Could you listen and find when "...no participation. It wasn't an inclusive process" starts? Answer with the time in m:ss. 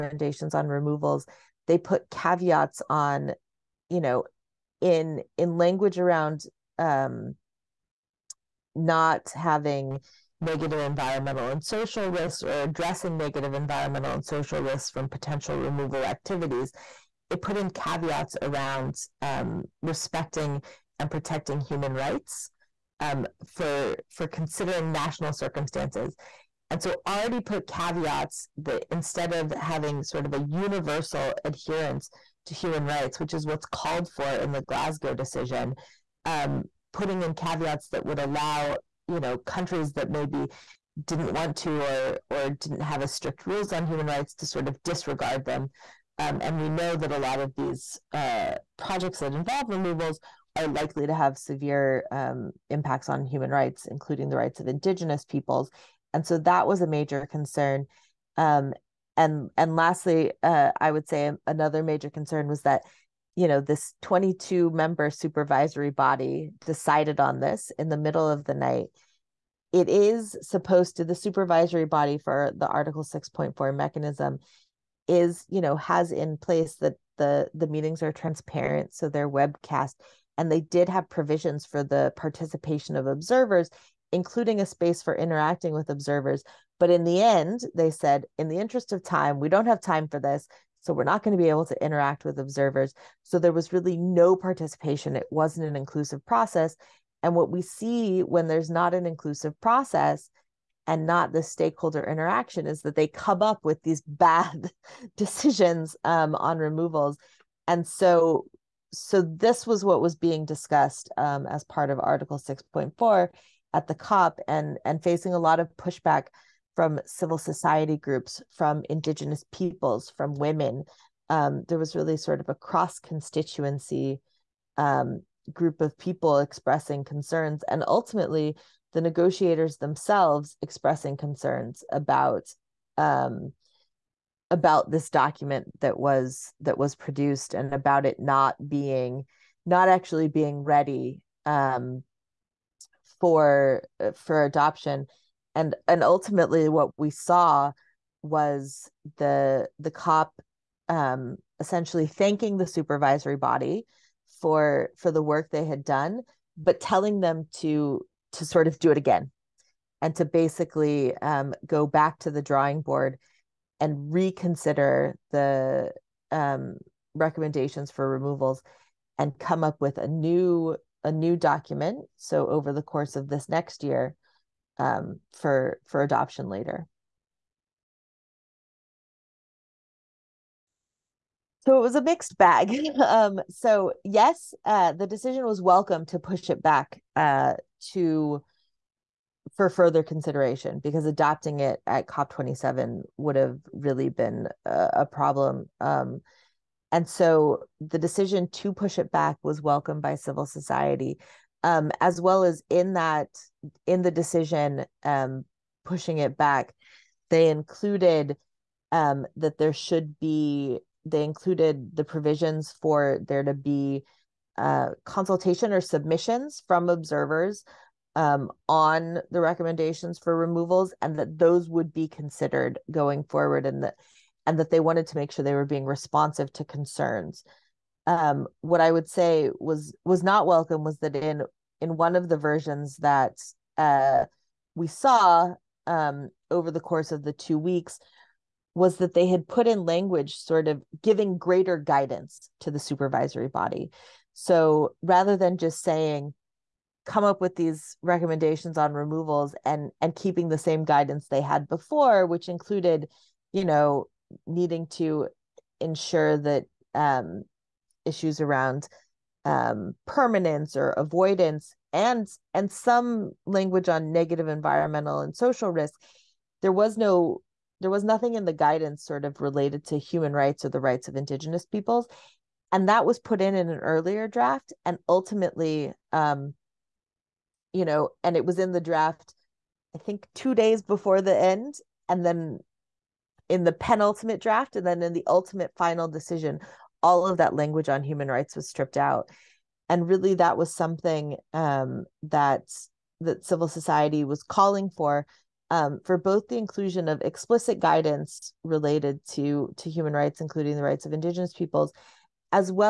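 1:33.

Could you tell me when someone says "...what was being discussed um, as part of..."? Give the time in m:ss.
1:49.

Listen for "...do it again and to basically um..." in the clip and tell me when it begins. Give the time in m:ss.
2:38.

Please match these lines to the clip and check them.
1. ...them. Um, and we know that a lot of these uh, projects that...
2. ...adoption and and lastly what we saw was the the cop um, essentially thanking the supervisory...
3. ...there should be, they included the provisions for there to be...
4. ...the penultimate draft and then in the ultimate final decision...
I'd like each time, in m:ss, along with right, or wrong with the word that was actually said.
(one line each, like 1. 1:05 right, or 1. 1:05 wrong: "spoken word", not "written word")
1. 0:45 right
2. 2:24 wrong: "ultimately", not "lastly"
3. 3:29 right
4. 4:43 right.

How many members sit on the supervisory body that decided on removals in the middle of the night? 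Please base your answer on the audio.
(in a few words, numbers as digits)
22.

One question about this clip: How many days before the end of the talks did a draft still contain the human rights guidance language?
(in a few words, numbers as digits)
2.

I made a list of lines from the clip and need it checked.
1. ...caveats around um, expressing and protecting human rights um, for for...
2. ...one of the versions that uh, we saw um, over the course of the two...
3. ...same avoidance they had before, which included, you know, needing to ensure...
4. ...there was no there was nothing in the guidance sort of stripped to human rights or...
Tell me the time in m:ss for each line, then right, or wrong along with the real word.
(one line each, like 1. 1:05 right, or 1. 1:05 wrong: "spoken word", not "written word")
1. 0:17 wrong: "respecting", not "expressing"
2. 3:51 right
3. 4:10 wrong: "guidance", not "avoidance"
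4. 4:26 wrong: "related", not "stripped".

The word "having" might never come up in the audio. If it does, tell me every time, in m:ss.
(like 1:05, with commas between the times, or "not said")
0:09, 0:29.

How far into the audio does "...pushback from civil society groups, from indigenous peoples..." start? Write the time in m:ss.
1:55.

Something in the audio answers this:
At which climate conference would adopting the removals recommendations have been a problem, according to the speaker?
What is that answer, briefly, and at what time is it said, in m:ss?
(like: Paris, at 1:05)
COP27, at 3:12.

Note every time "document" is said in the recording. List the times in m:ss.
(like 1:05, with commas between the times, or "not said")
2:15, 2:51.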